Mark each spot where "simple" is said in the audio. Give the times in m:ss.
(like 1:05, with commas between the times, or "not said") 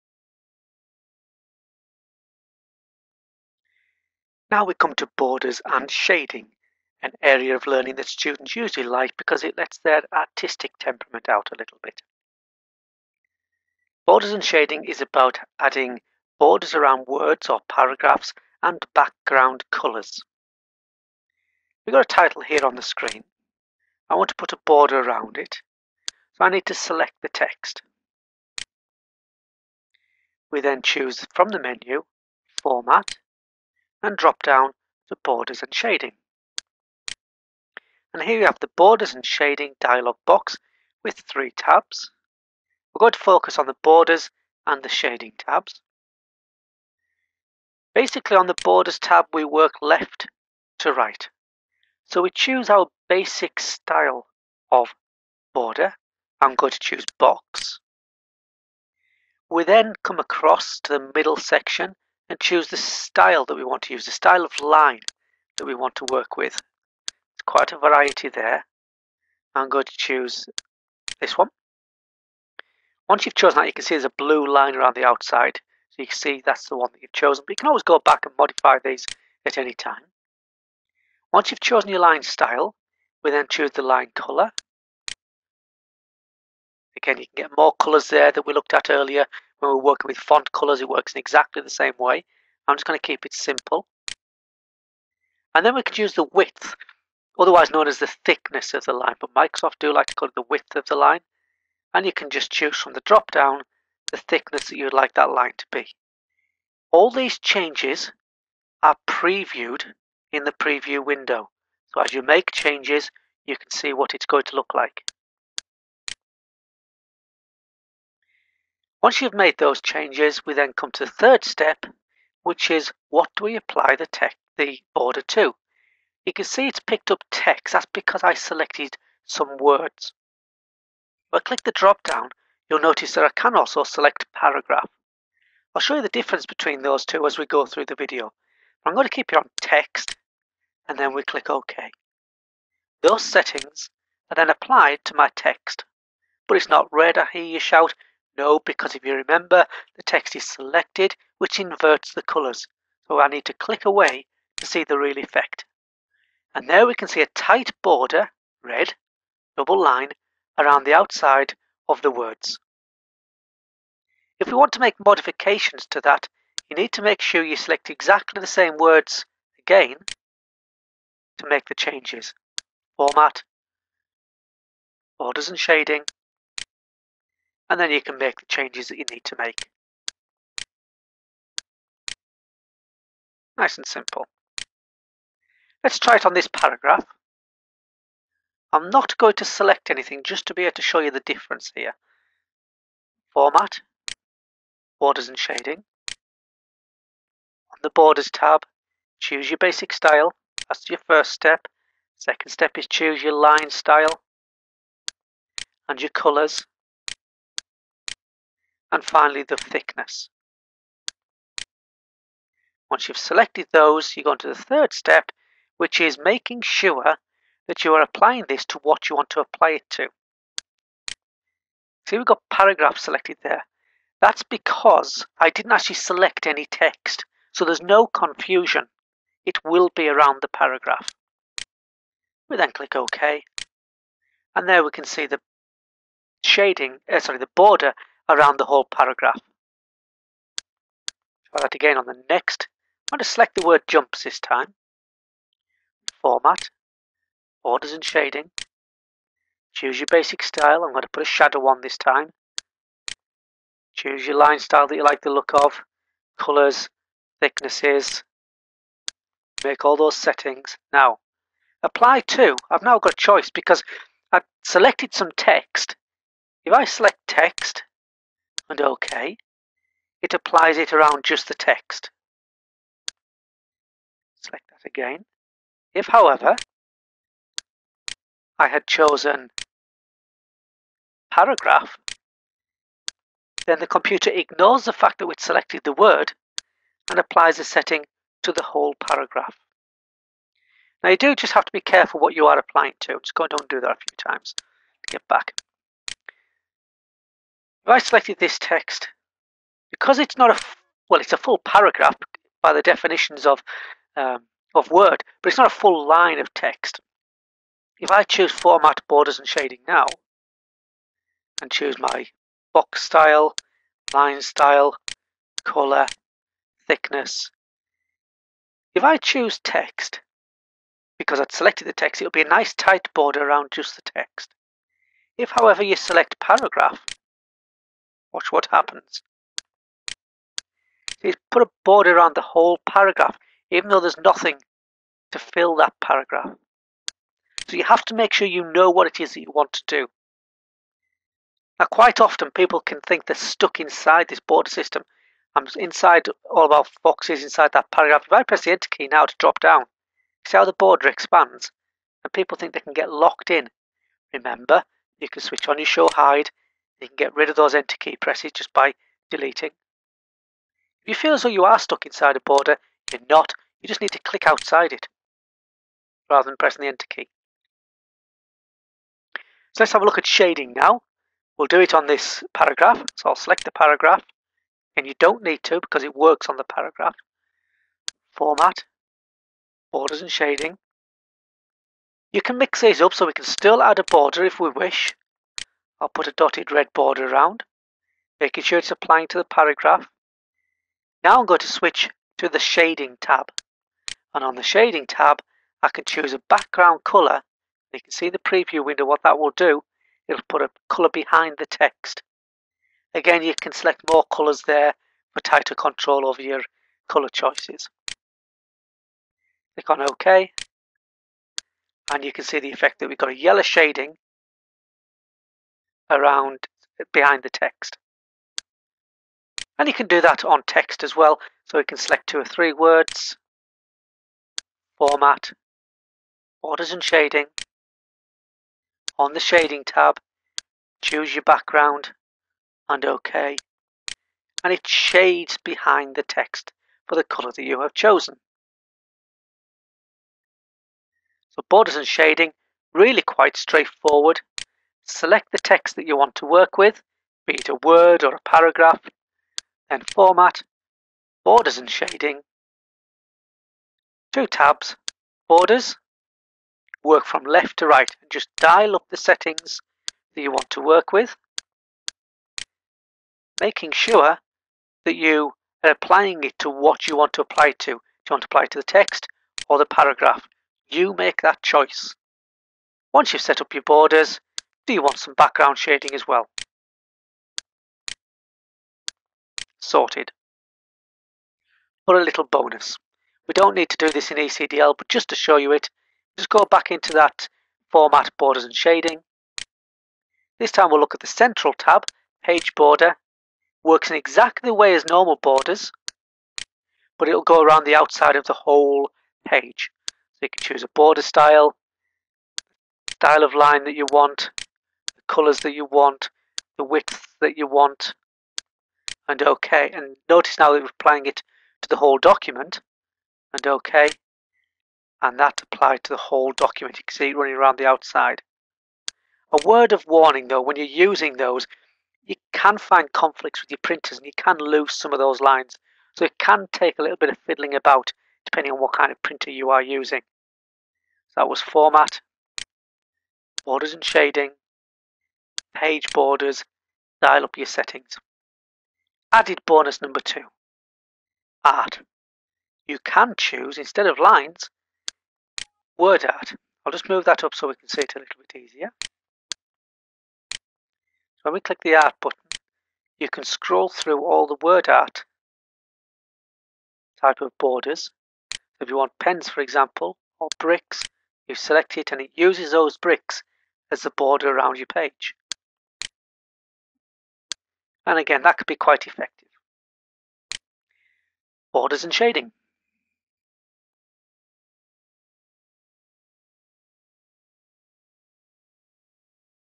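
1:33, 3:03.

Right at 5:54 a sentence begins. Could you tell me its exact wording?
Remember, you can switch on your show hide you can get rid of those enter key presses just by deleting.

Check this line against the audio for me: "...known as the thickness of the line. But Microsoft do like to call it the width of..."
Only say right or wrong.
right.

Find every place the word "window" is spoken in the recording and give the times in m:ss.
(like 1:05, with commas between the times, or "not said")
1:51, 6:38.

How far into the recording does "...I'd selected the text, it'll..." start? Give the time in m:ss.
5:21.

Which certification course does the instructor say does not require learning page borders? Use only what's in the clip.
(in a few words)
ECDL.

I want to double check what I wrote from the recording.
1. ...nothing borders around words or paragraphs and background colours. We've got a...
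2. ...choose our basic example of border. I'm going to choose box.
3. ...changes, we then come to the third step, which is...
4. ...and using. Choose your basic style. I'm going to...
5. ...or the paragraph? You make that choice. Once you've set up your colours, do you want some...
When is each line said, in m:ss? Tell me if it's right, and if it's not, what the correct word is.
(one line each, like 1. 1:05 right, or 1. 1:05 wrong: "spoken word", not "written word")
1. 0:15 wrong: "adding", not "nothing"
2. 0:52 wrong: "style", not "example"
3. 1:59 right
4. 4:07 wrong: "shading", not "using"
5. 7:49 wrong: "borders", not "colours".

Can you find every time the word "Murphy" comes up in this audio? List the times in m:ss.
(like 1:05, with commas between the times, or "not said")
not said.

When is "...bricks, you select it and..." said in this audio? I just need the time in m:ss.
9:20.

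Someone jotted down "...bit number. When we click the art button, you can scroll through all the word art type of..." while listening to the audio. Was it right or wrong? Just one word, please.
wrong.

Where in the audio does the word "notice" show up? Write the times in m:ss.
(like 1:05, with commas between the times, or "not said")
2:12, 8:30.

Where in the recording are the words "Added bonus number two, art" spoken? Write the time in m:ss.
8:59.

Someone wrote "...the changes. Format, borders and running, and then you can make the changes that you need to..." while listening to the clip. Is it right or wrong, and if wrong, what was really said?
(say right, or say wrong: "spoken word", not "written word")
wrong: "shading", not "running".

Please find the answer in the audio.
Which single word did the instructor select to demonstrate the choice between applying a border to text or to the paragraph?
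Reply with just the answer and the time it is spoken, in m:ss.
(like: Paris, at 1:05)
jumps, at 4:03.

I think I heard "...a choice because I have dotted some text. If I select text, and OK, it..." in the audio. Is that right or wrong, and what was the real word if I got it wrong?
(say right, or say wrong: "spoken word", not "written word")
wrong: "selected", not "dotted".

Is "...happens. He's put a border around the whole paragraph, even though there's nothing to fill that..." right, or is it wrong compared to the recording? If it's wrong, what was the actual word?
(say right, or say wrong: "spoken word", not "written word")
right.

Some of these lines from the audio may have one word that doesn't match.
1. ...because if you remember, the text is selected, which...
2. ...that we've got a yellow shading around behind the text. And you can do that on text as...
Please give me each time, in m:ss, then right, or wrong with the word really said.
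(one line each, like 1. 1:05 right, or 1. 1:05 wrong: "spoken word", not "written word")
1. 2:28 right
2. 6:52 right.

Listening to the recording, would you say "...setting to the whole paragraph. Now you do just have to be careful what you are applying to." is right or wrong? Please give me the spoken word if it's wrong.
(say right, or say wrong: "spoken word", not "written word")
right.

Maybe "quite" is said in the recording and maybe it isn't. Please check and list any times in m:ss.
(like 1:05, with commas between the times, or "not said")
1:07, 5:41, 7:23, 9:28.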